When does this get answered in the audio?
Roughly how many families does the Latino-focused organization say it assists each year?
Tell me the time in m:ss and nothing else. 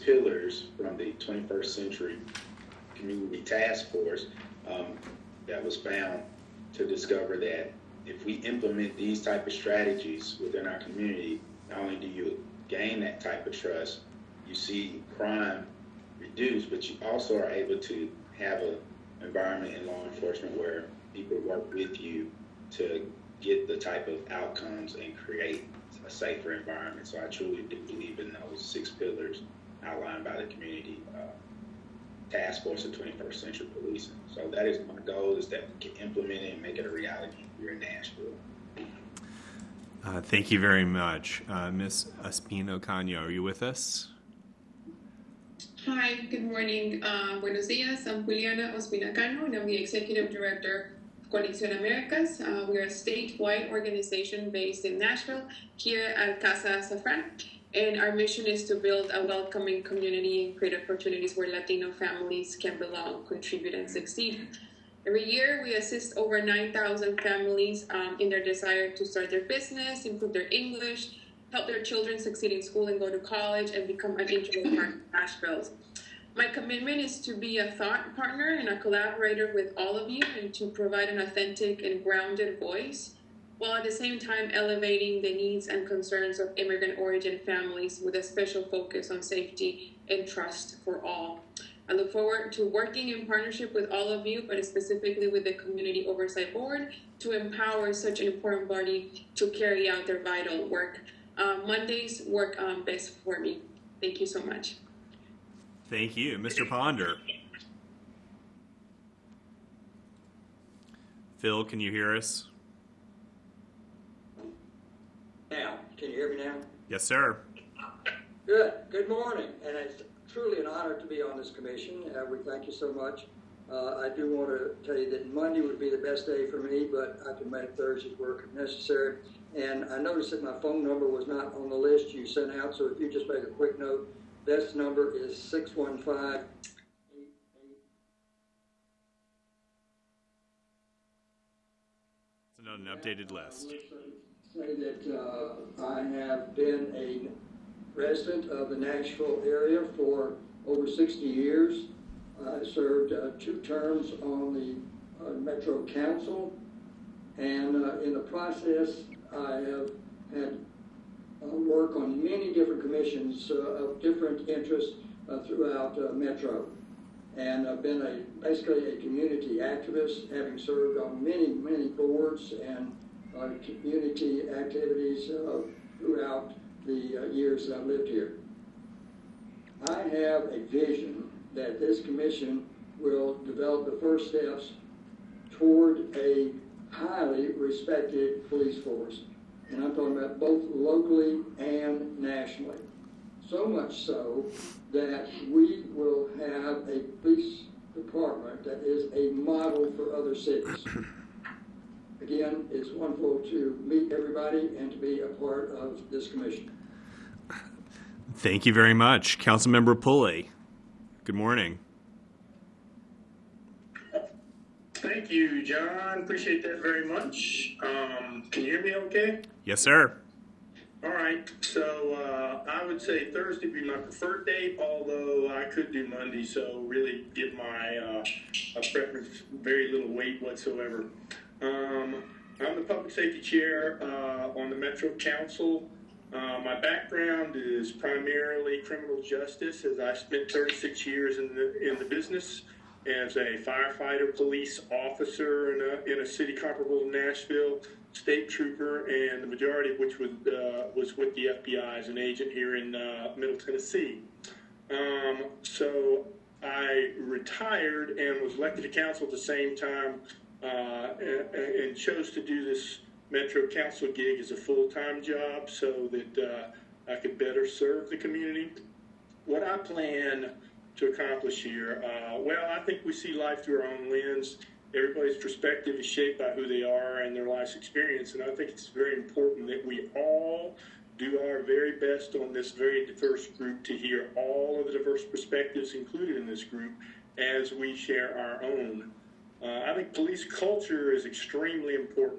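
1:06.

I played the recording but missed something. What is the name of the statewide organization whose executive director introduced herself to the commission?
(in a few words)
Conexión Américas.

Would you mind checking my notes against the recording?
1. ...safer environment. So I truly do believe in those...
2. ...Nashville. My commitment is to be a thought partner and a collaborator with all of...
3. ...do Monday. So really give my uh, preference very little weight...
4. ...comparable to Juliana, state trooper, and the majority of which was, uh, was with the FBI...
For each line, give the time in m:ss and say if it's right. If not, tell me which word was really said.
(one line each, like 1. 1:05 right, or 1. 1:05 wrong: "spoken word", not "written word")
1. 0:26 right
2. 1:15 right
3. 3:45 right
4. 4:06 wrong: "Nashville", not "Juliana".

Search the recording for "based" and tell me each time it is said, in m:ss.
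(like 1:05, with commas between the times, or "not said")
0:54.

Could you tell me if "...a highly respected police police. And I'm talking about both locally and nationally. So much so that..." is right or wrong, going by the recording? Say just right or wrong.
wrong.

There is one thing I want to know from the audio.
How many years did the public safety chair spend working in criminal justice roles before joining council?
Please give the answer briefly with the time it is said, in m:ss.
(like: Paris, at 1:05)
36, at 4:00.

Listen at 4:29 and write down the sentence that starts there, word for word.
What I plan to accomplish here?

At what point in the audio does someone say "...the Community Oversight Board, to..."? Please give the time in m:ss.
1:35.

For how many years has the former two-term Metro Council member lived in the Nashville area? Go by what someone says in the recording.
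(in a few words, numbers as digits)
over 60 years.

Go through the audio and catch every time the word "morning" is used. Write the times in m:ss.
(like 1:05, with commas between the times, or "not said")
0:46, 1:59, 3:31.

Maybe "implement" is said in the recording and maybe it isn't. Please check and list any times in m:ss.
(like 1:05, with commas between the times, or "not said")
0:08, 0:36.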